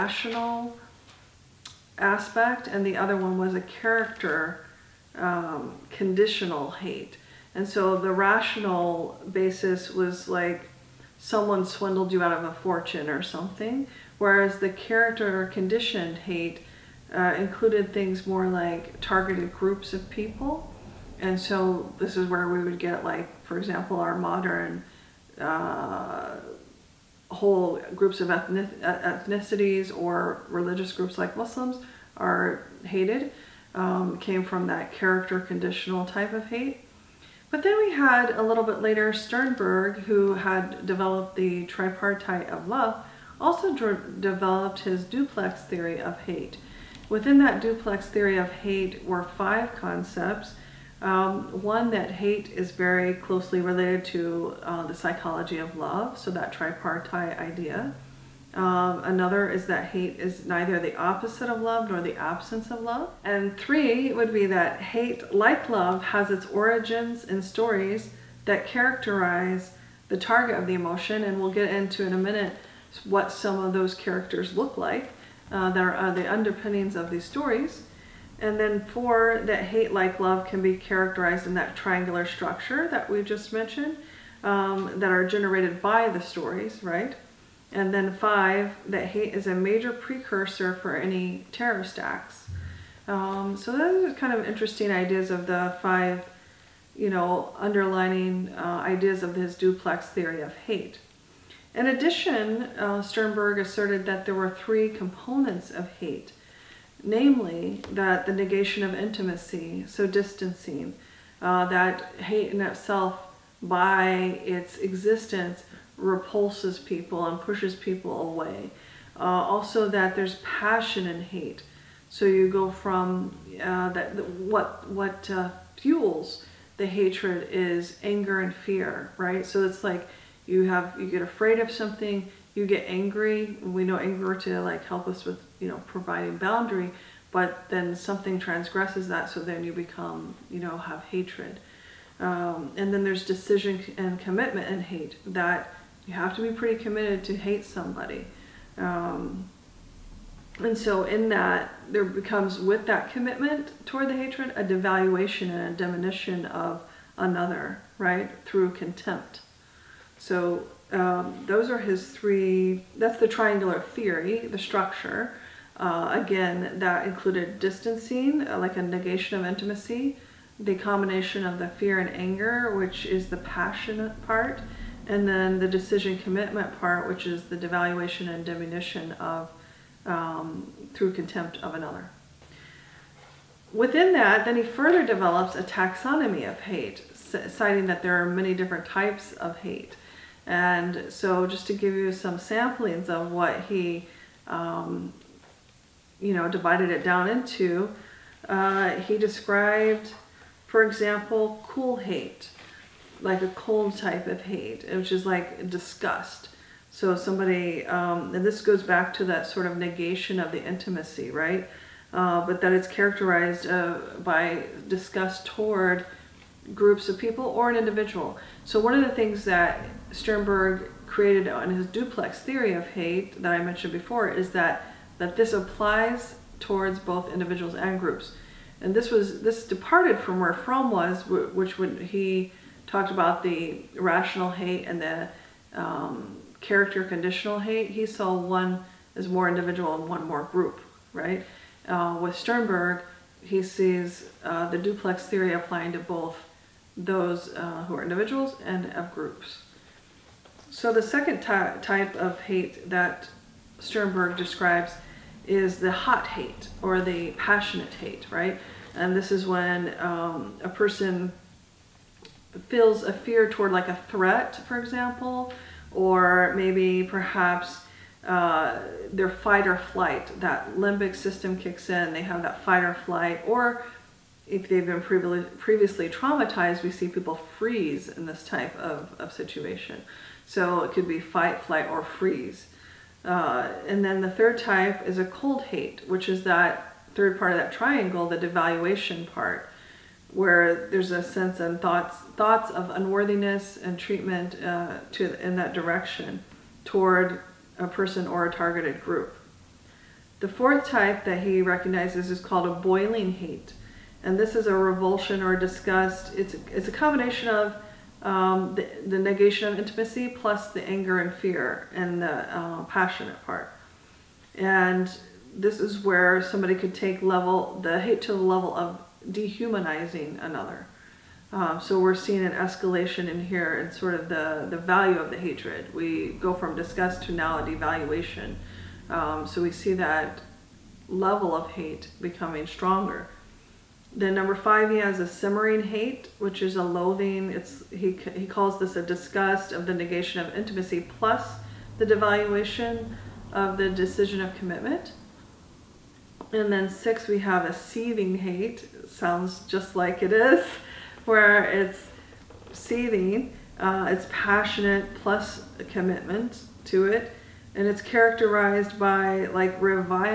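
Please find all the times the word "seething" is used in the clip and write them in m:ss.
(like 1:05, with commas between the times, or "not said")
5:47, 5:52.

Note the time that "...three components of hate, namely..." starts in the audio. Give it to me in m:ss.
1:44.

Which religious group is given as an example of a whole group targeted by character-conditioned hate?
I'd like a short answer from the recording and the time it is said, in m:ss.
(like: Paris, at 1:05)
Muslims, at 0:31.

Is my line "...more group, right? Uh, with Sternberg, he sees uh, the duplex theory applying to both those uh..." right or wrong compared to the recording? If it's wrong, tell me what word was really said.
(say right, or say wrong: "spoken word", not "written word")
right.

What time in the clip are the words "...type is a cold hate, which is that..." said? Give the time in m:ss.
4:44.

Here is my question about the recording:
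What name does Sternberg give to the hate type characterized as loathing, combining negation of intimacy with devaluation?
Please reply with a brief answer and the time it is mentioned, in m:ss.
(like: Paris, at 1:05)
simmering hate, at 5:35.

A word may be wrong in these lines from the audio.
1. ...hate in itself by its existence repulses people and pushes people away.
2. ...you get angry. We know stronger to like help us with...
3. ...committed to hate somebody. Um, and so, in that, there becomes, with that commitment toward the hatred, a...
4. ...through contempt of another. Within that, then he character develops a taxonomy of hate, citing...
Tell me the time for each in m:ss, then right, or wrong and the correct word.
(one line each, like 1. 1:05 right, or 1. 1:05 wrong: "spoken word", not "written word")
1. 1:52 right
2. 2:12 wrong: "anger", not "stronger"
3. 2:26 right
4. 3:00 wrong: "further", not "character".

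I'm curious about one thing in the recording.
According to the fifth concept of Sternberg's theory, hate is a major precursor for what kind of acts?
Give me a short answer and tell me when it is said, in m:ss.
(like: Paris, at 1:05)
terrorist acts, at 1:31.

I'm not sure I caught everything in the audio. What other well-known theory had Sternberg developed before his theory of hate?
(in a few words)
tripartite of love.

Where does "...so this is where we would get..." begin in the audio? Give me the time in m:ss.
0:21.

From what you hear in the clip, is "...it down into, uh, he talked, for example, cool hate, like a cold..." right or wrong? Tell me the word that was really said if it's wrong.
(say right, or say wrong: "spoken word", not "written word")
wrong: "described", not "talked".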